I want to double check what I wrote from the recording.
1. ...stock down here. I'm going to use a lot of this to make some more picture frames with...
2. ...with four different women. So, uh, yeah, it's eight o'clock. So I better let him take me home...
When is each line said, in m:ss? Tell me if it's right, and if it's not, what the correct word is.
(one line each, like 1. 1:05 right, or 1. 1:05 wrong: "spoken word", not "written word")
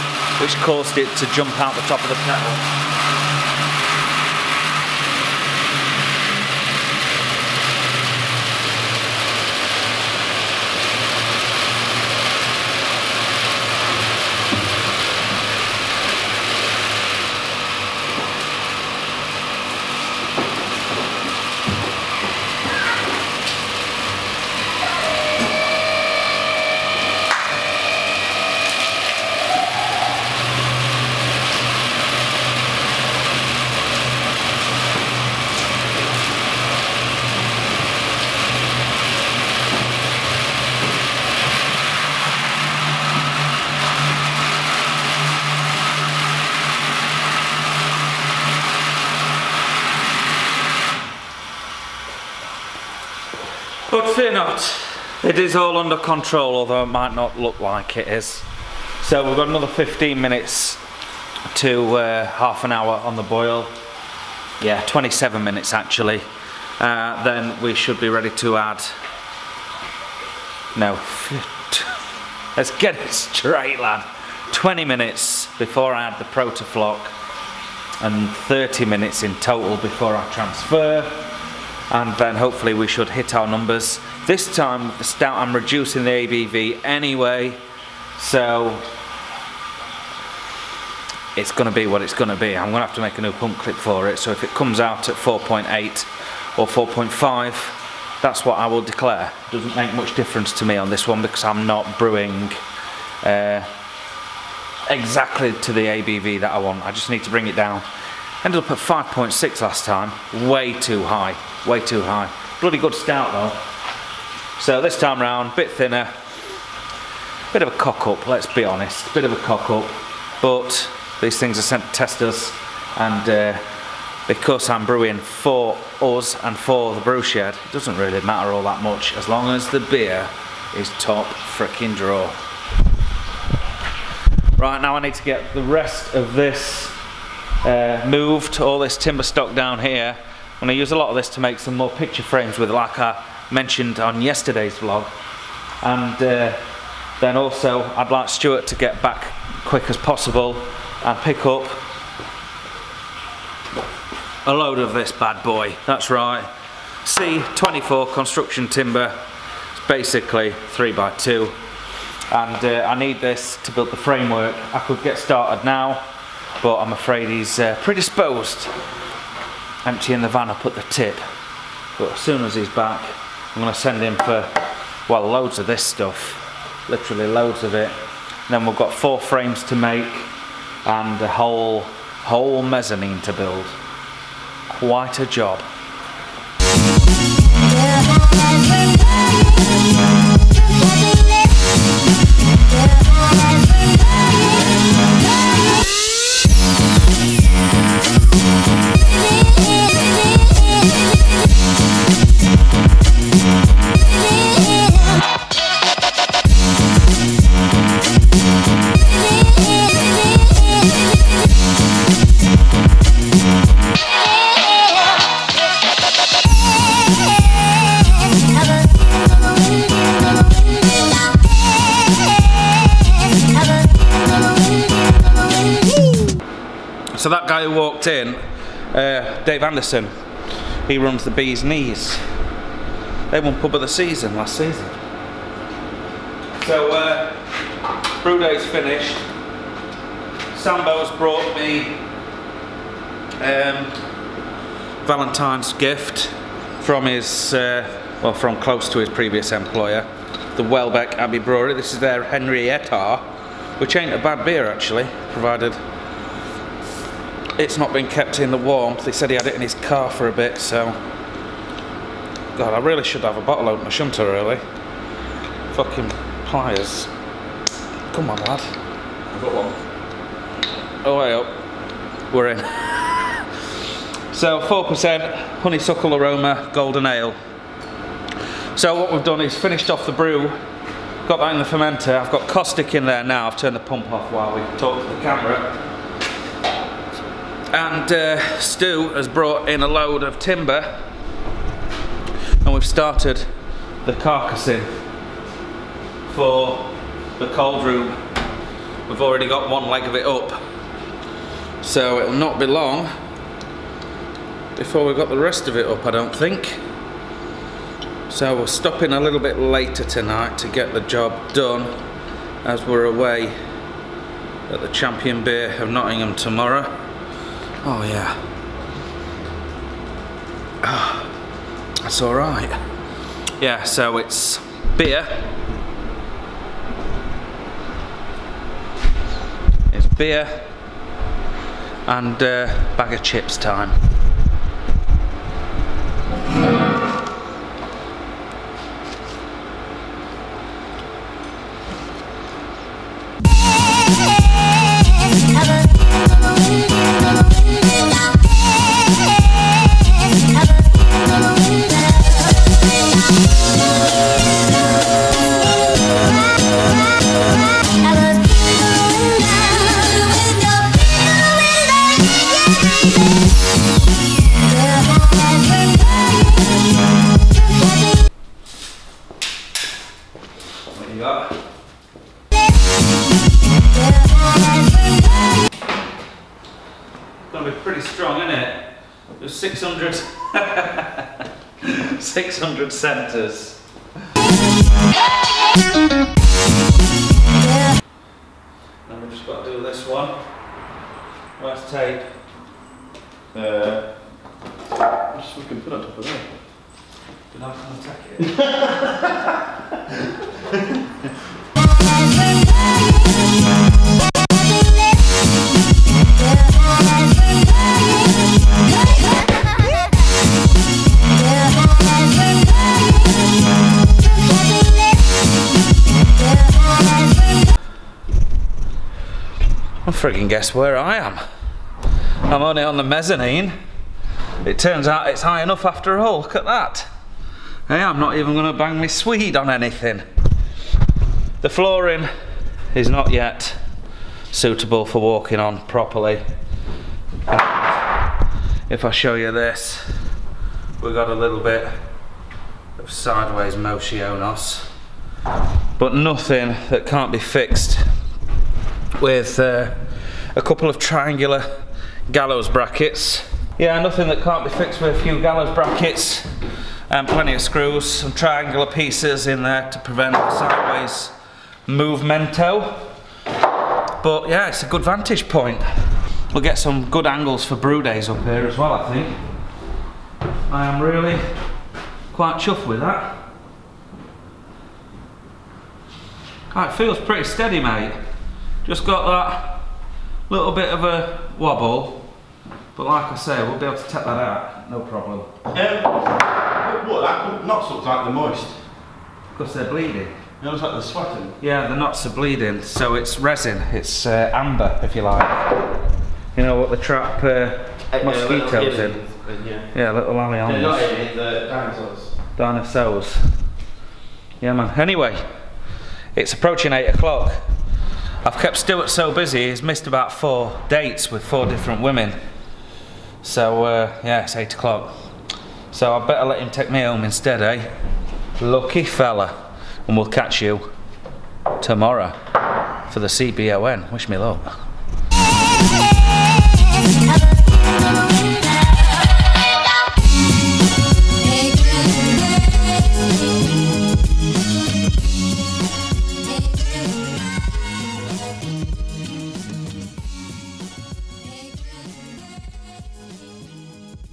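1. 2:19 right
2. 8:31 right.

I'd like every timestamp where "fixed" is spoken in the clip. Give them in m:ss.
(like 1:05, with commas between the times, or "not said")
7:27, 7:34.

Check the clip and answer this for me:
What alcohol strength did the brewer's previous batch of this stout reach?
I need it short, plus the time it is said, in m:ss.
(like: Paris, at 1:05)
5.6, at 1:48.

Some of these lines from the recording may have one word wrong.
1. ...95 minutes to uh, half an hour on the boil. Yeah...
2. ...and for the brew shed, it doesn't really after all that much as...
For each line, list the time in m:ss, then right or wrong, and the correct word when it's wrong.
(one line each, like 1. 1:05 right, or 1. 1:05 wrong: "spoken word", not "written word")
1. 0:59 wrong: "15", not "95"
2. 2:06 wrong: "matter", not "after".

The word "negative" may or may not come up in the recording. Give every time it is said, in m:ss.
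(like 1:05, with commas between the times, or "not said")
not said.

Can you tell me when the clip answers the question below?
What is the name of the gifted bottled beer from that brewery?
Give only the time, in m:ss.
4:12.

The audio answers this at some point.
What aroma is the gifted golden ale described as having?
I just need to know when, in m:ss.
4:35.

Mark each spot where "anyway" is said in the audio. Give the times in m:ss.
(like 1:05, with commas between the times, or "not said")
1:26, 8:25.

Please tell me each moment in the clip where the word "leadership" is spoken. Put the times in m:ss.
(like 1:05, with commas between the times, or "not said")
not said.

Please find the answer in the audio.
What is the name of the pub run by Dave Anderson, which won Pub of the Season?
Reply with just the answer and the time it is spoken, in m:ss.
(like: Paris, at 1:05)
Bees Knees, at 3:51.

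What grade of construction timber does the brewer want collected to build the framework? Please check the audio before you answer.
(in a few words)
C24.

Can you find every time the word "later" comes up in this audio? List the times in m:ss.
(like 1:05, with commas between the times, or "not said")
5:09.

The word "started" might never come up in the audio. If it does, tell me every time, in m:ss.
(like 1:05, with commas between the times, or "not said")
2:45, 4:52.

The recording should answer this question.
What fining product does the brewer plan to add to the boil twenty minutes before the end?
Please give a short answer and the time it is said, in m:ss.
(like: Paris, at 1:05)
Protofloc, at 1:16.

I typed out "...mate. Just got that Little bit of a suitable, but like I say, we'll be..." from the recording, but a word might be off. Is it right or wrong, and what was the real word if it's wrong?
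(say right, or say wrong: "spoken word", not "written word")
wrong: "wobble", not "suitable".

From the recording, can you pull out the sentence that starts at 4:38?
So what we've done is finished off the brew, got that in the fermenter.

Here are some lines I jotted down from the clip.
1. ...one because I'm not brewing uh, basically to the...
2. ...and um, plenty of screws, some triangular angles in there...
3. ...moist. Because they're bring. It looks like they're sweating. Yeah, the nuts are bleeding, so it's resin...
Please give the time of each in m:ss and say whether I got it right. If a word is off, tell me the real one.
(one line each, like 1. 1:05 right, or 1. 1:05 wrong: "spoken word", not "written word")
1. 1:41 wrong: "exactly", not "basically"
2. 7:37 wrong: "pieces", not "angles"
3. 8:08 wrong: "bleeding", not "bring".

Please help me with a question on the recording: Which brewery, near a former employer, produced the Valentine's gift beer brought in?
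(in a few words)
Welbeck Abbey Brewery.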